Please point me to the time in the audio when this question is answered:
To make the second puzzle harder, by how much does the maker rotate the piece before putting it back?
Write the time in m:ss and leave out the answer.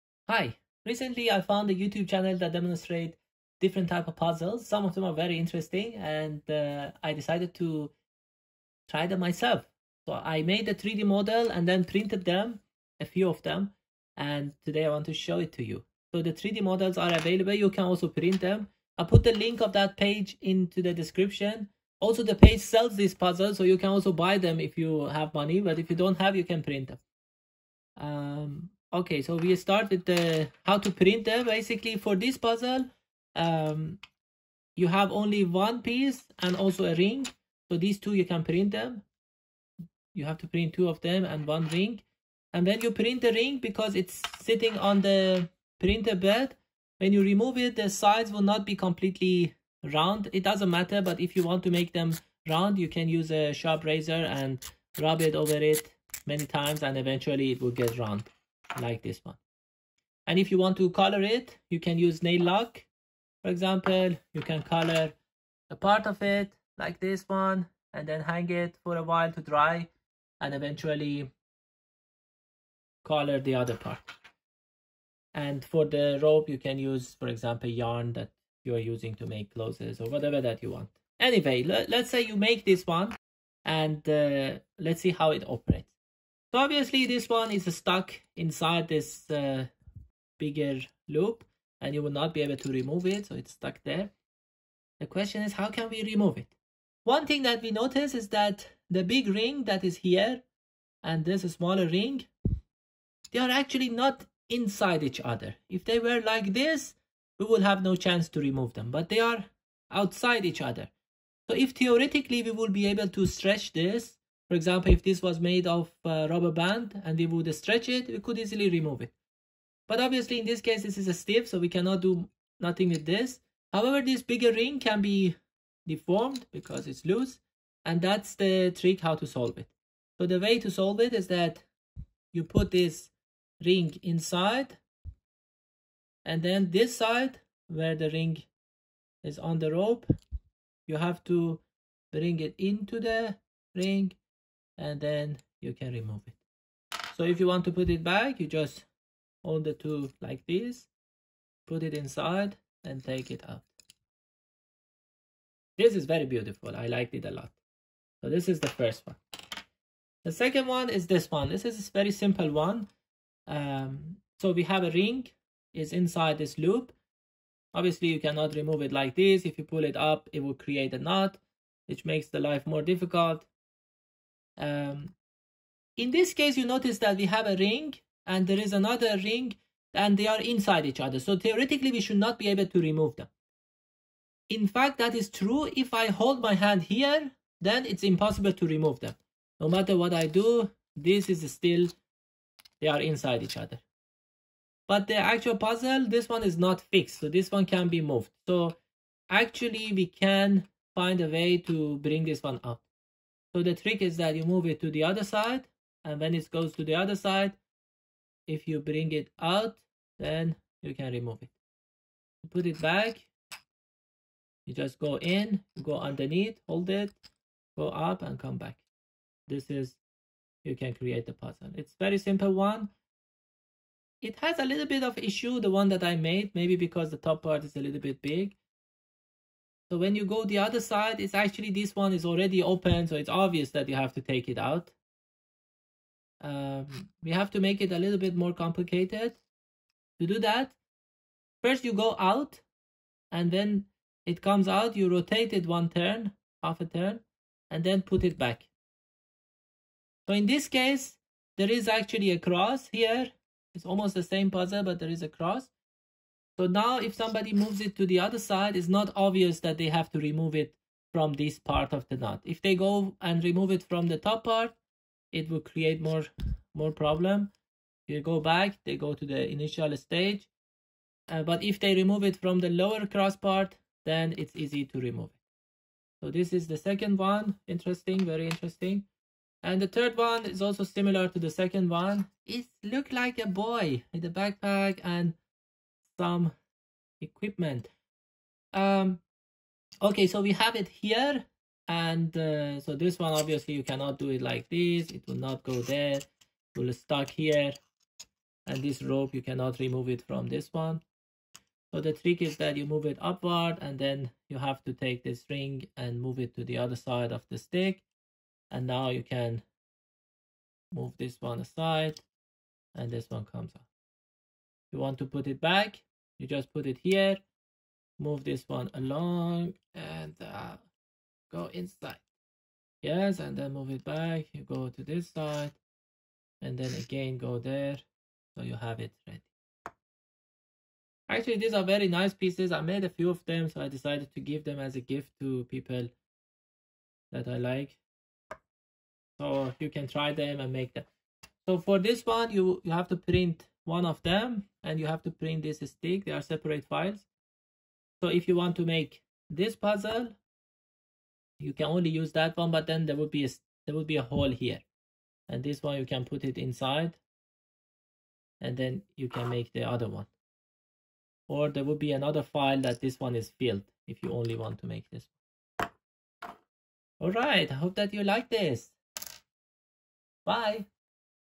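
4:06.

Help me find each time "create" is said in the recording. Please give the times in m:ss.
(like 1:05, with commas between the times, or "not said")
2:50, 3:40, 4:25.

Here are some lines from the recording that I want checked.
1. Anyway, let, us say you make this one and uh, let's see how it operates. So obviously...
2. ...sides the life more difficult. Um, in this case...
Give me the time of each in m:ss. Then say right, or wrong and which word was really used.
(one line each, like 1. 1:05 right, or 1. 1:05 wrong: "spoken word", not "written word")
1. 1:21 right
2. 2:52 wrong: "makes", not "sides".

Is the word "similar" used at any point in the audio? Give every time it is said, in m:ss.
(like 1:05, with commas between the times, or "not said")
4:40.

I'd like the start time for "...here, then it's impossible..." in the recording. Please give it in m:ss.
3:06.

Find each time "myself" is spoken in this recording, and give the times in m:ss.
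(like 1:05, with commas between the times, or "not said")
0:09.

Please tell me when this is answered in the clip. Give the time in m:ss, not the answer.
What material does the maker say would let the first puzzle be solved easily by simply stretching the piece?
1:56.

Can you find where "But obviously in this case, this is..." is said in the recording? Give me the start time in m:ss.
1:59.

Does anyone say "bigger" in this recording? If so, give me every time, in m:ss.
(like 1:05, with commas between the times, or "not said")
1:30, 2:04.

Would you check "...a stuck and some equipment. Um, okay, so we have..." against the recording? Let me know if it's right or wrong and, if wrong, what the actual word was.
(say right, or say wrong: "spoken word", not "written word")
wrong: "backpack", not "stuck".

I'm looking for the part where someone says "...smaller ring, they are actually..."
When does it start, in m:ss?
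1:41.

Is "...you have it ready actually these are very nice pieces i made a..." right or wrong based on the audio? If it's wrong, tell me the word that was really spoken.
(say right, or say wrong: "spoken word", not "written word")
right.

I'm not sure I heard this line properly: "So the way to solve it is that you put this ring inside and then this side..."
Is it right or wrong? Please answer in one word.
right.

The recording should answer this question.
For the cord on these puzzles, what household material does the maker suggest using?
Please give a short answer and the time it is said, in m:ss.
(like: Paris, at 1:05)
yarn, at 1:17.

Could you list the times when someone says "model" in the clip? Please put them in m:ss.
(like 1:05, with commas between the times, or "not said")
0:11, 0:16.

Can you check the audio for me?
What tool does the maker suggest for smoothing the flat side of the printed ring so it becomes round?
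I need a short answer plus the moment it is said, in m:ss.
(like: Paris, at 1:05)
sharp razor, at 0:53.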